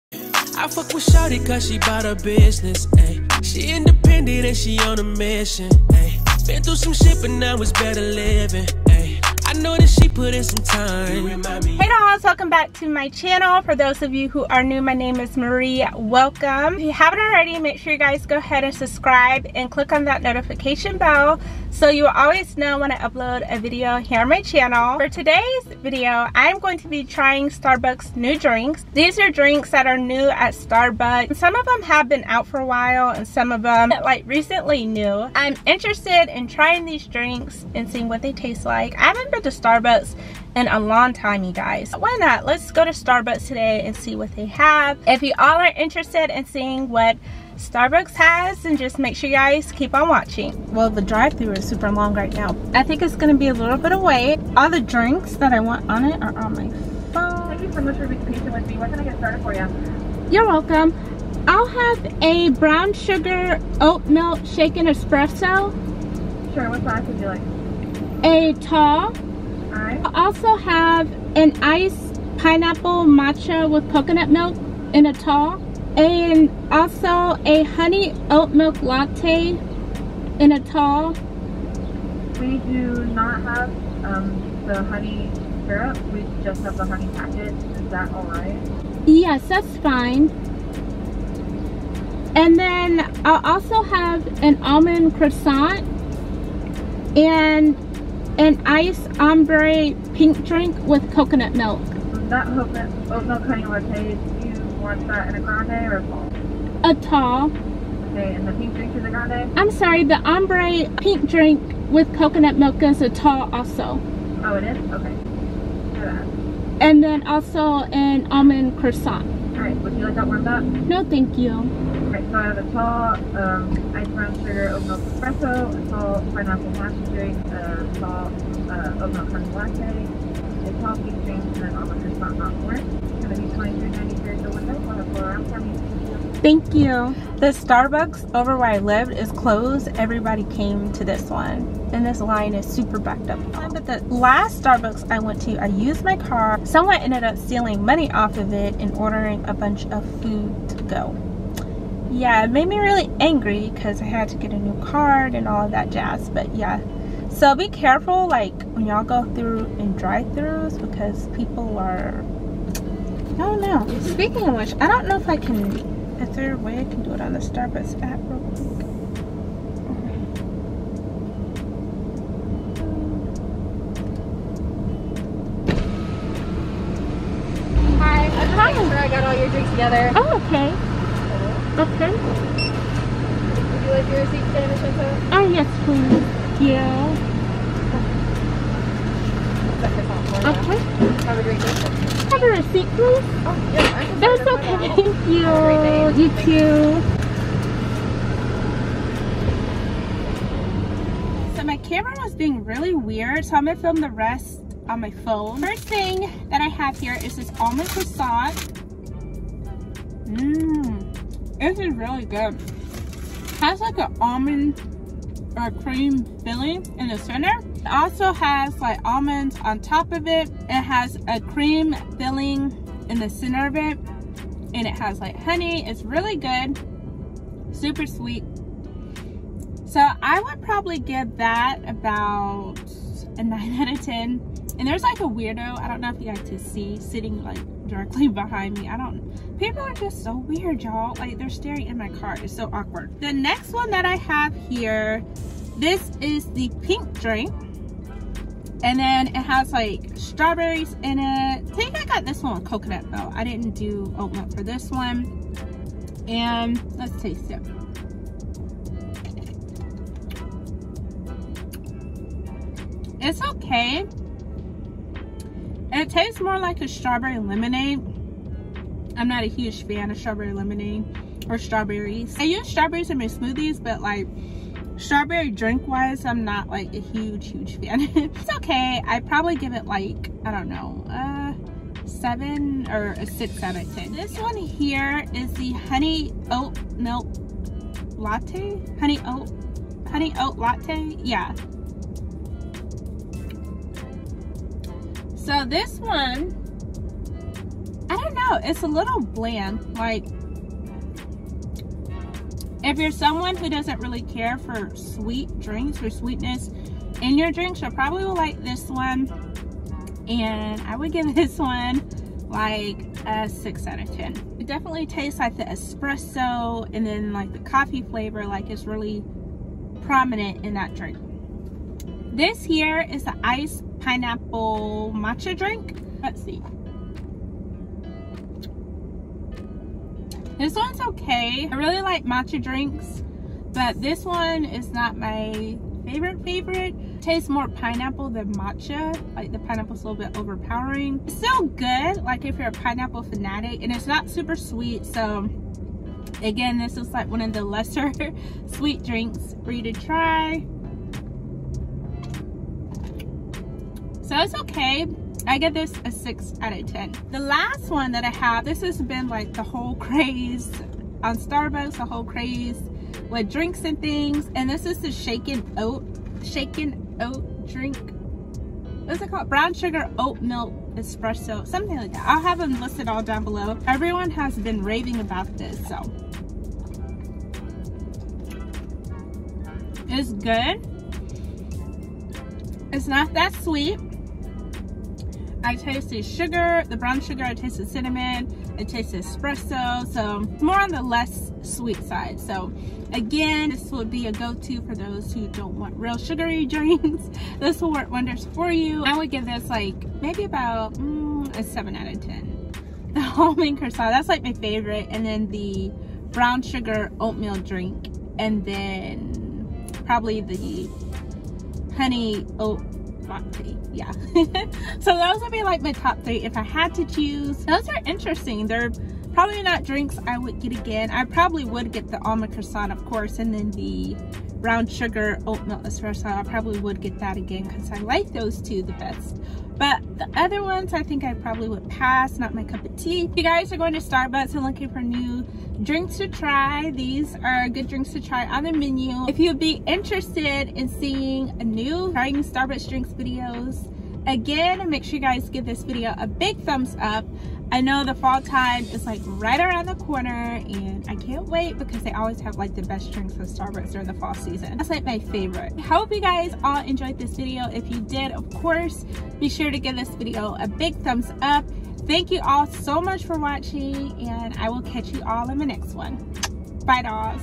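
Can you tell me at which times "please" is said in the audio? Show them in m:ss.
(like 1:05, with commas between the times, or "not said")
3:05, 3:12.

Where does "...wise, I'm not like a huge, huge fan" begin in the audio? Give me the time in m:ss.
4:35.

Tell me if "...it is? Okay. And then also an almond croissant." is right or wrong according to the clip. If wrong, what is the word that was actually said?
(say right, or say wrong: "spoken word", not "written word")
right.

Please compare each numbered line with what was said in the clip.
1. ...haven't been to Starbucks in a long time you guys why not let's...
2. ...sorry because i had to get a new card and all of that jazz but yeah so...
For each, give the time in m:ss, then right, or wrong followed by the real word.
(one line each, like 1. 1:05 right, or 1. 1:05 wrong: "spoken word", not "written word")
1. 0:39 right
2. 2:33 wrong: "angry", not "sorry".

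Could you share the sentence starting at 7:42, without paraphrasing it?
Thank you all so much for watching and I will catch you all in the next one.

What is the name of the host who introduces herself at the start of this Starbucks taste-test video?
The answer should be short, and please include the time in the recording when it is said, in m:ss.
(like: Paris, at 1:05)
Marie, at 0:15.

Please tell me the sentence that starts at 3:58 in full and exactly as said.
I don't, people are just so weird, y'all.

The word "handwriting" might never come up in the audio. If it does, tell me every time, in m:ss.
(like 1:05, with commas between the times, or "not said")
not said.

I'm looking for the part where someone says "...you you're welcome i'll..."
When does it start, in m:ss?
0:59.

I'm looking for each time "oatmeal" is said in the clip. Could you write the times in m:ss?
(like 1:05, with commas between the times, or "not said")
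6:47.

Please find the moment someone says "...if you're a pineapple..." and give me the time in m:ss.
5:42.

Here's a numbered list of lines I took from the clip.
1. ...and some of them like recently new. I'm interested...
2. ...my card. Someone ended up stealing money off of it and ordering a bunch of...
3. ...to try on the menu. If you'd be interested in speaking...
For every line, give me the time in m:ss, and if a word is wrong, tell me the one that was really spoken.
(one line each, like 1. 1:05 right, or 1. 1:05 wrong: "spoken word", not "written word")
1. 0:33 right
2. 2:26 right
3. 7:18 wrong: "seeing", not "speaking".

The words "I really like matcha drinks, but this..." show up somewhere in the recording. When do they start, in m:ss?
5:31.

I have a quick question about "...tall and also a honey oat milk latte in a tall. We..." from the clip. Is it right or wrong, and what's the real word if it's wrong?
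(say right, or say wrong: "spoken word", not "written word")
right.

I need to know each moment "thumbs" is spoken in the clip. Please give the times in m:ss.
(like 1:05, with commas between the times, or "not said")
7:26, 7:40.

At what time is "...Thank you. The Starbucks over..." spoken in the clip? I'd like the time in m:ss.
2:16.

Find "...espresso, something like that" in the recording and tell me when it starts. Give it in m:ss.
6:10.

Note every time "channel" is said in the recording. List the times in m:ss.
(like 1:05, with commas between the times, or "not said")
0:13, 0:24.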